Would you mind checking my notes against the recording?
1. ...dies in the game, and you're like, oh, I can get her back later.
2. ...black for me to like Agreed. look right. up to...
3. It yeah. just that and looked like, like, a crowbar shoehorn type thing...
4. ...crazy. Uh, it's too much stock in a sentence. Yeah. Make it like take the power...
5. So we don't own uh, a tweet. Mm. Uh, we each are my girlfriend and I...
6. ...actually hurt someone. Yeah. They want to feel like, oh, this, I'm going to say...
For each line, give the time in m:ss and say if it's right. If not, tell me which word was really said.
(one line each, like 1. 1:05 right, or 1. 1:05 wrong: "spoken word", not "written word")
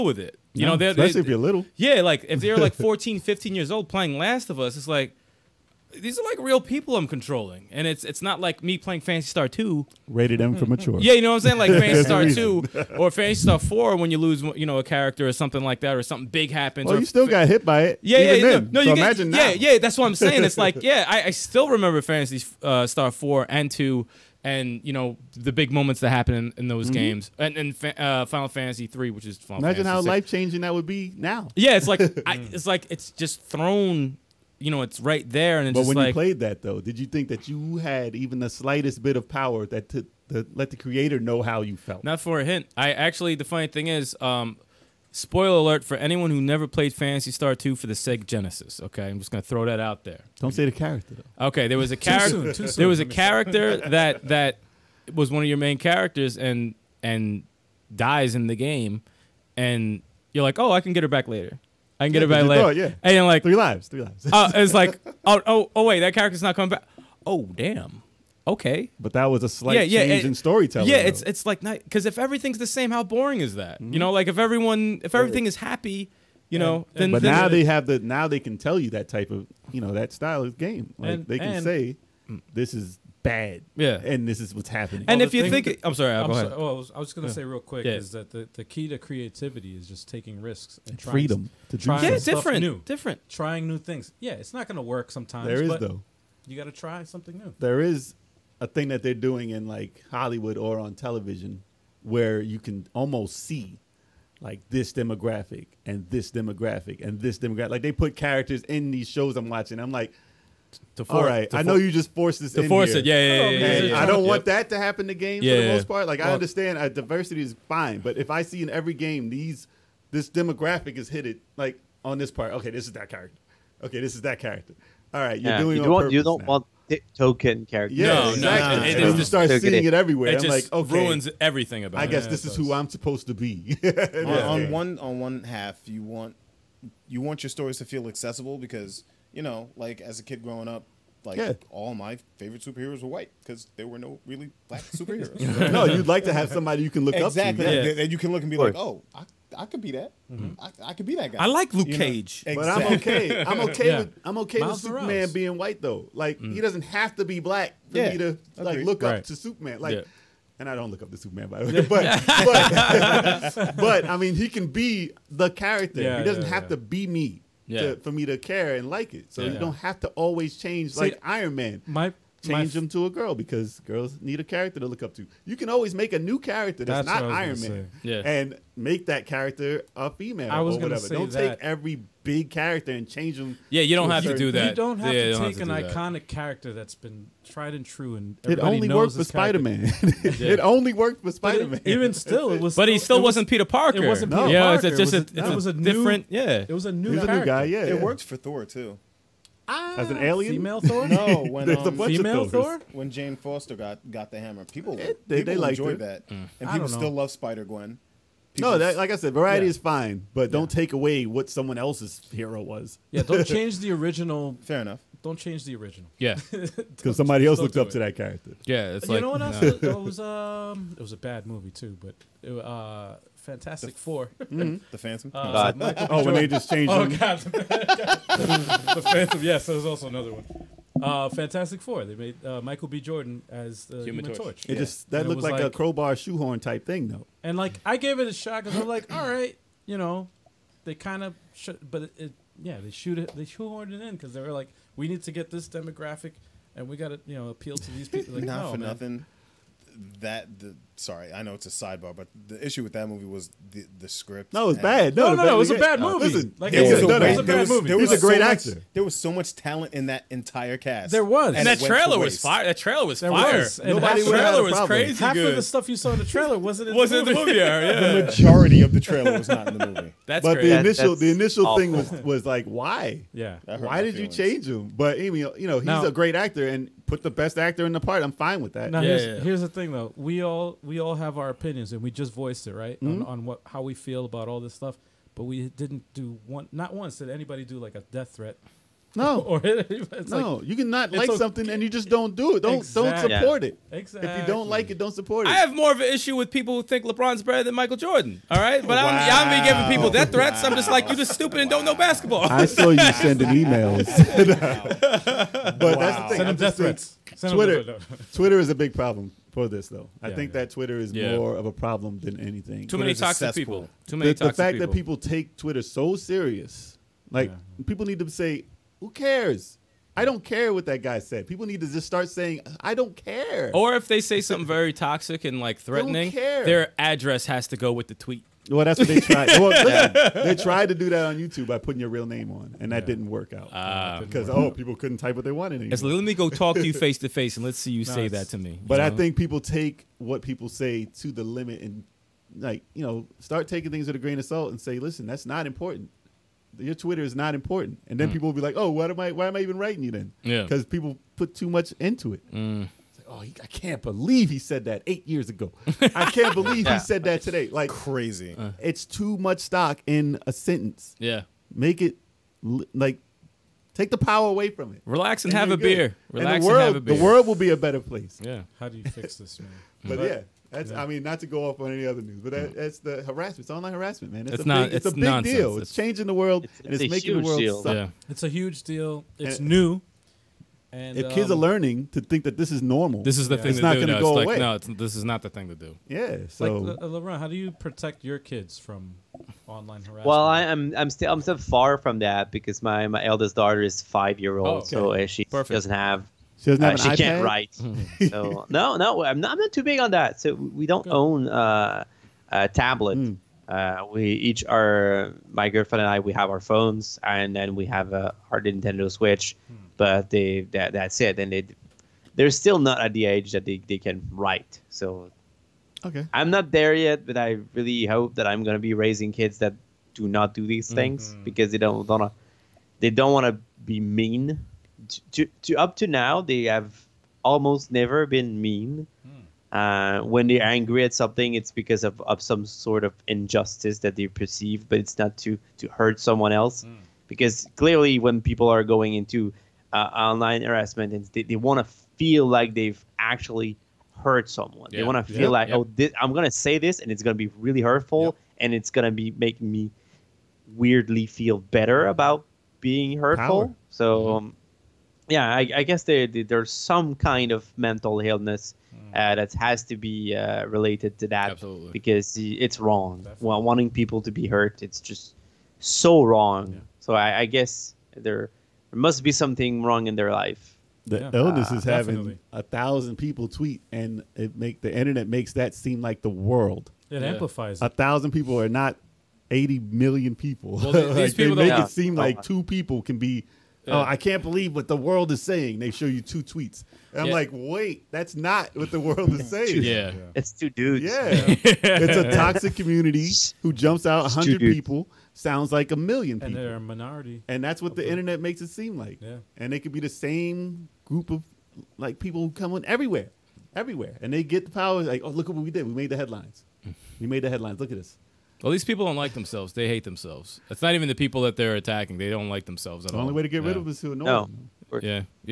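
1. 0:57 right
2. 2:37 right
3. 3:54 right
4. 5:57 right
5. 6:40 wrong: "tablet", not "tweet"
6. 7:23 right.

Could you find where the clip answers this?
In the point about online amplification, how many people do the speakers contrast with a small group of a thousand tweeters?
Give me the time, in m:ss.
7:59.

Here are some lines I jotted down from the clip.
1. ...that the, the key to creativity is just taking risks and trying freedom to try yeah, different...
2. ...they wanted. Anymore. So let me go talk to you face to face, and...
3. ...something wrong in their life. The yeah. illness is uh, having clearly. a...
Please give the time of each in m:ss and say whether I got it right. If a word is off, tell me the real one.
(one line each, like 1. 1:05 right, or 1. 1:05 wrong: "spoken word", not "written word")
1. 1:28 right
2. 5:35 right
3. 7:49 wrong: "definitely", not "clearly".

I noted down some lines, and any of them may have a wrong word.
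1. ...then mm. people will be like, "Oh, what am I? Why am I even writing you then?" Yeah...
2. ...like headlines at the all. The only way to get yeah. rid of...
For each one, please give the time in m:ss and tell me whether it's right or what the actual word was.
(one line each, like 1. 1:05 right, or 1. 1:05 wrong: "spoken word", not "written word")
1. 5:48 right
2. 8:32 wrong: "themselves", not "headlines".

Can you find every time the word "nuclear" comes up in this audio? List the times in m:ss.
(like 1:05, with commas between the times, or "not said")
not said.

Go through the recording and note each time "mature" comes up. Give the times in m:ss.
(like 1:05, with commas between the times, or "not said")
0:10.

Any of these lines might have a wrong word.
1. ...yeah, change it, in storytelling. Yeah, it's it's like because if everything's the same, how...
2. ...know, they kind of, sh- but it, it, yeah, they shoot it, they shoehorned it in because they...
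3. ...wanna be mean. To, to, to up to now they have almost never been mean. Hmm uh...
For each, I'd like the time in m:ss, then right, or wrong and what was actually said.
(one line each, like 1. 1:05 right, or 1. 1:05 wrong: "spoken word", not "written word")
1. 1:09 right
2. 3:59 right
3. 7:03 right.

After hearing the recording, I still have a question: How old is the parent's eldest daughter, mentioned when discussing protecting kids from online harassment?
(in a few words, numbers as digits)
5.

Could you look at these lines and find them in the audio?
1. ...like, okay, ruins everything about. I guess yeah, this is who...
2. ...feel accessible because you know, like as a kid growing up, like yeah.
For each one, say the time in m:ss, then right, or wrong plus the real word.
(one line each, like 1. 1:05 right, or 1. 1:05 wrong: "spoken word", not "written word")
1. 2:10 right
2. 2:17 right.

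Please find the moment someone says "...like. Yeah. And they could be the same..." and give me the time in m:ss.
8:18.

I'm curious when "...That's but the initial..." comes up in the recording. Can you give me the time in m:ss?
4:30.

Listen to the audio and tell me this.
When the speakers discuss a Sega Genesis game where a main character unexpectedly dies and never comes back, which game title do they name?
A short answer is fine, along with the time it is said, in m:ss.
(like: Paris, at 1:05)
Phantasy Star 2, at 0:46.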